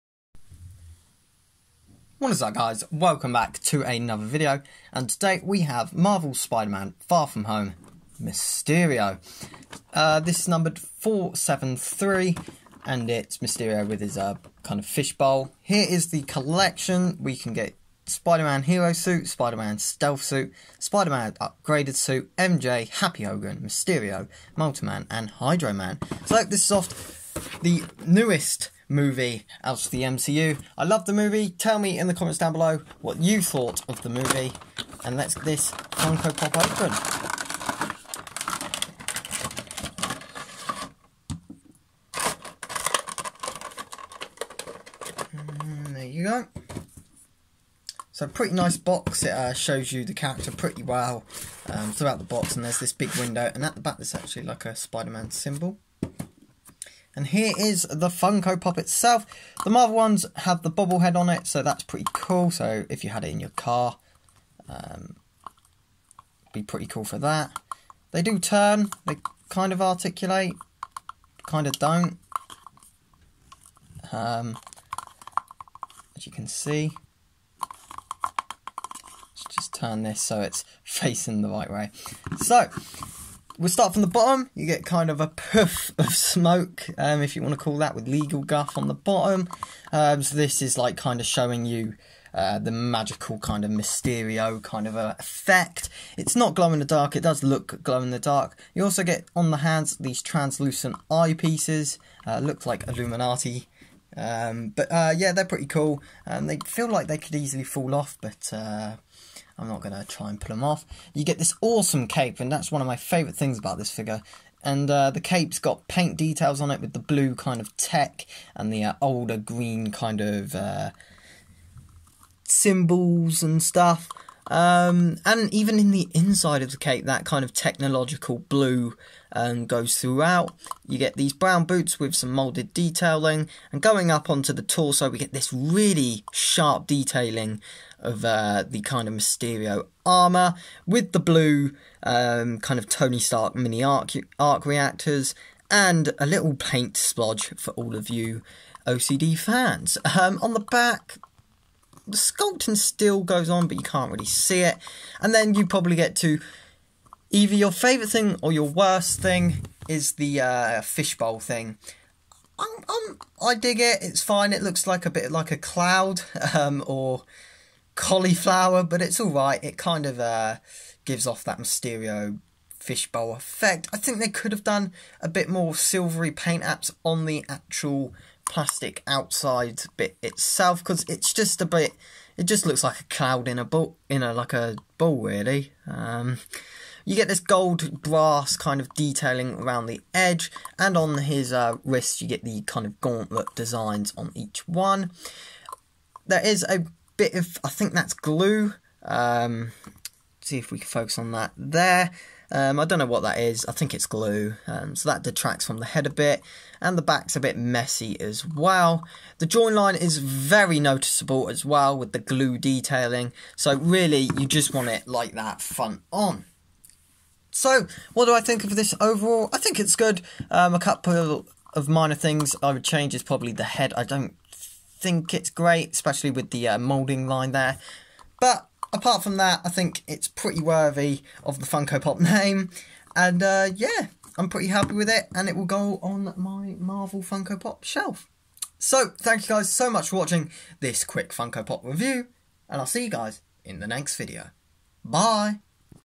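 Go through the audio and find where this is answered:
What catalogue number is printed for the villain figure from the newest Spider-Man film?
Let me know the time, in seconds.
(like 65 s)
10 s.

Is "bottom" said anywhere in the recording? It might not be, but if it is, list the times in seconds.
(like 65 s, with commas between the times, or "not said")
84 s, 88 s.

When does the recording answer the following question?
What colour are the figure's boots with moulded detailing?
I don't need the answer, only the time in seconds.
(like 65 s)
131 s.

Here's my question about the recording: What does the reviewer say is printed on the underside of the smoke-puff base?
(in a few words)
legal guff.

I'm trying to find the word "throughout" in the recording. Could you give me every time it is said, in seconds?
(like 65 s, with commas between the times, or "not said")
51 s, 129 s.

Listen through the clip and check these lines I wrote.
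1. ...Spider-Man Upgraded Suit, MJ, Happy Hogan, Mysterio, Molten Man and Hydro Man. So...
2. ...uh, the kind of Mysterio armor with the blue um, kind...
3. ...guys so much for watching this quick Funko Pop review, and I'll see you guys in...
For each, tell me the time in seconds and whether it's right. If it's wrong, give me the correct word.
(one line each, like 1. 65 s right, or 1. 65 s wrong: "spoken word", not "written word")
1. 20 s right
2. 138 s right
3. 239 s right.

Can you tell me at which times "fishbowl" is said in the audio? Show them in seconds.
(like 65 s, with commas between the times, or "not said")
14 s, 160 s, 172 s.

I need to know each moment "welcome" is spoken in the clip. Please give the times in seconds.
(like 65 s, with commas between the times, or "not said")
2 s.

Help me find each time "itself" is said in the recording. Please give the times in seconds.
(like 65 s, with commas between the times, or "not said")
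58 s, 180 s.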